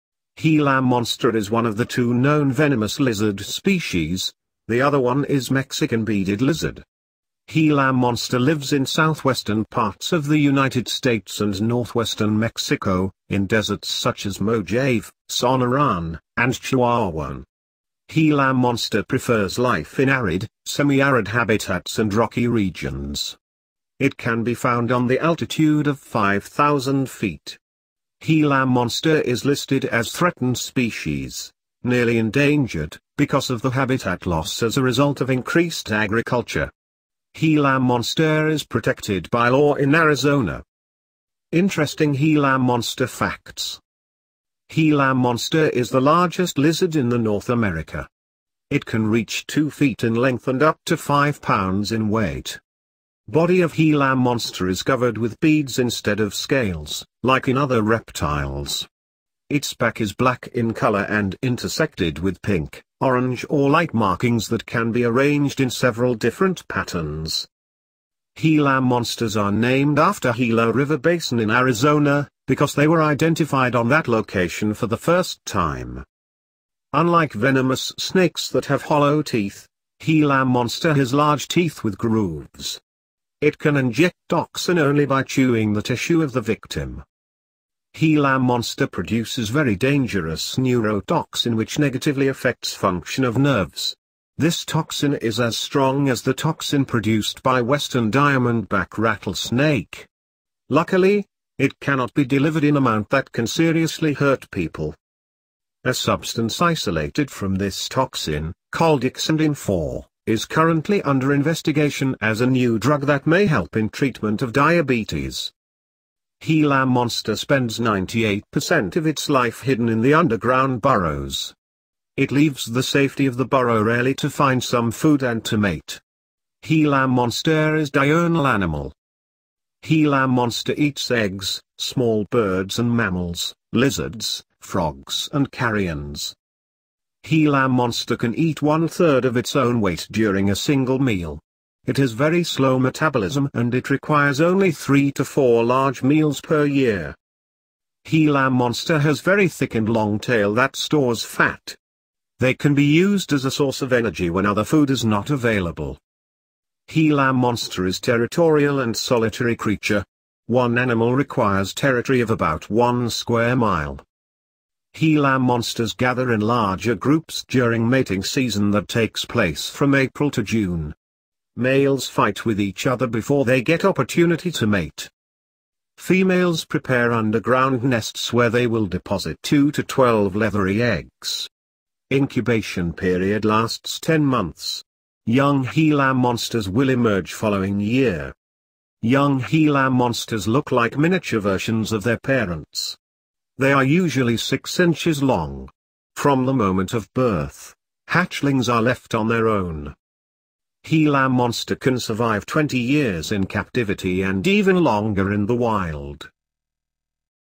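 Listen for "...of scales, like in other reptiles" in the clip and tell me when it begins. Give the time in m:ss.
0:56.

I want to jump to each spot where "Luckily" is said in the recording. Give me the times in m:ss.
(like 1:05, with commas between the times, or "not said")
1:40.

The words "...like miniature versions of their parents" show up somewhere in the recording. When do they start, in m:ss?
3:10.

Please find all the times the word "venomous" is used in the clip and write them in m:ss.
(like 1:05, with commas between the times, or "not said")
0:02, 1:17.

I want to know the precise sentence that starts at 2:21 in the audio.
It has very slow metabolism and it requires only 3 to 4 large meals per year.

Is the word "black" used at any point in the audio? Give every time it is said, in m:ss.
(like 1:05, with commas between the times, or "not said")
1:00.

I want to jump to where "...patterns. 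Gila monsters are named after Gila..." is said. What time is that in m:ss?
1:06.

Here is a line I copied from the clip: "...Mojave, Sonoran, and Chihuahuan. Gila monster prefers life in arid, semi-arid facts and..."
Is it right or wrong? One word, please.
wrong.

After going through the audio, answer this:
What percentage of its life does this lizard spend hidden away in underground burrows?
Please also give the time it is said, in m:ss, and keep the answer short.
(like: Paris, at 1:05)
98%, at 1:57.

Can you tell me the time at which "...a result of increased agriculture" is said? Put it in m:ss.
0:34.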